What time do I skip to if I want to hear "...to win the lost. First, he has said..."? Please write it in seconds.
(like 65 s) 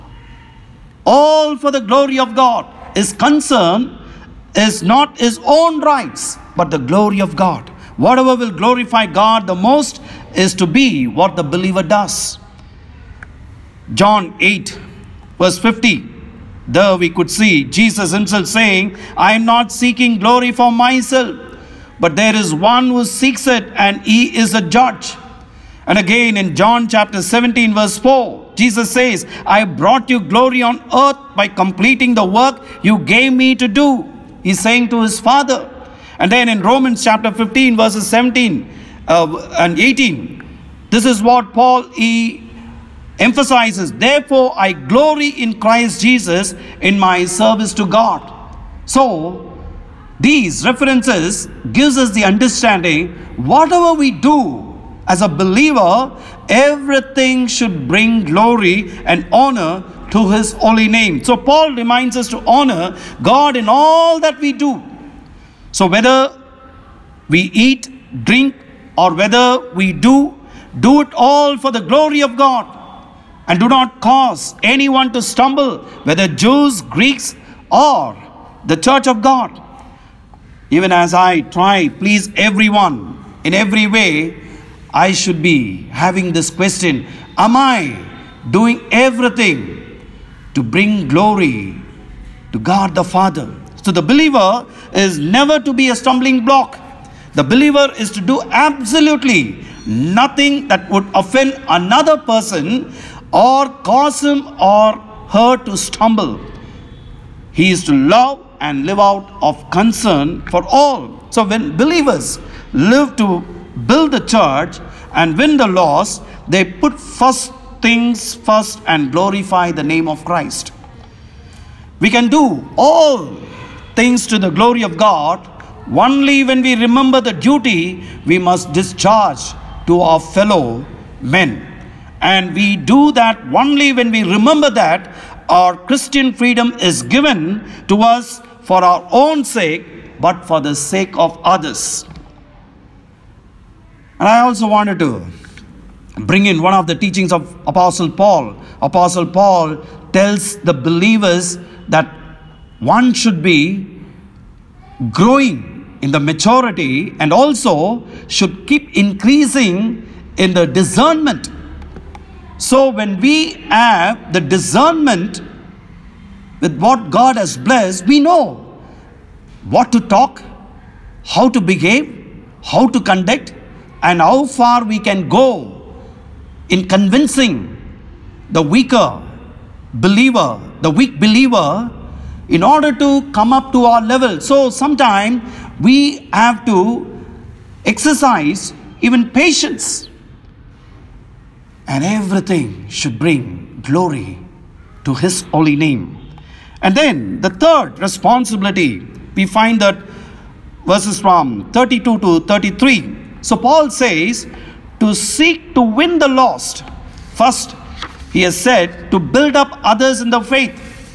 205 s.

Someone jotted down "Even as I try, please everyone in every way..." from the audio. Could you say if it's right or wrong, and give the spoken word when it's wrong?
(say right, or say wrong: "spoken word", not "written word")
right.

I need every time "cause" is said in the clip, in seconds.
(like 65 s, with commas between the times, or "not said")
74 s, 103 s.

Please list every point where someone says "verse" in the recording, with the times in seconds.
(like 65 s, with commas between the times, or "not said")
15 s, 27 s, 37 s, 200 s.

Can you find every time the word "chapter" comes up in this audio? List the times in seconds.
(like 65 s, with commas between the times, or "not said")
26 s, 37 s.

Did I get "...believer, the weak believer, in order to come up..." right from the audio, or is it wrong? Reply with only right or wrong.
right.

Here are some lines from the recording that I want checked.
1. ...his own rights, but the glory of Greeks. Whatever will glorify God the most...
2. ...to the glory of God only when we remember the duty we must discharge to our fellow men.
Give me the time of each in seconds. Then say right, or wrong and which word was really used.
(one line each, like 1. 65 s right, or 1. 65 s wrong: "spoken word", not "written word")
1. 5 s wrong: "God", not "Greeks"
2. 124 s right.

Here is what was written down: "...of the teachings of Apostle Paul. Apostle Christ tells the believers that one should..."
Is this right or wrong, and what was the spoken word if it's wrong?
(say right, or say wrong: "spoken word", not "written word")
wrong: "Paul", not "Christ".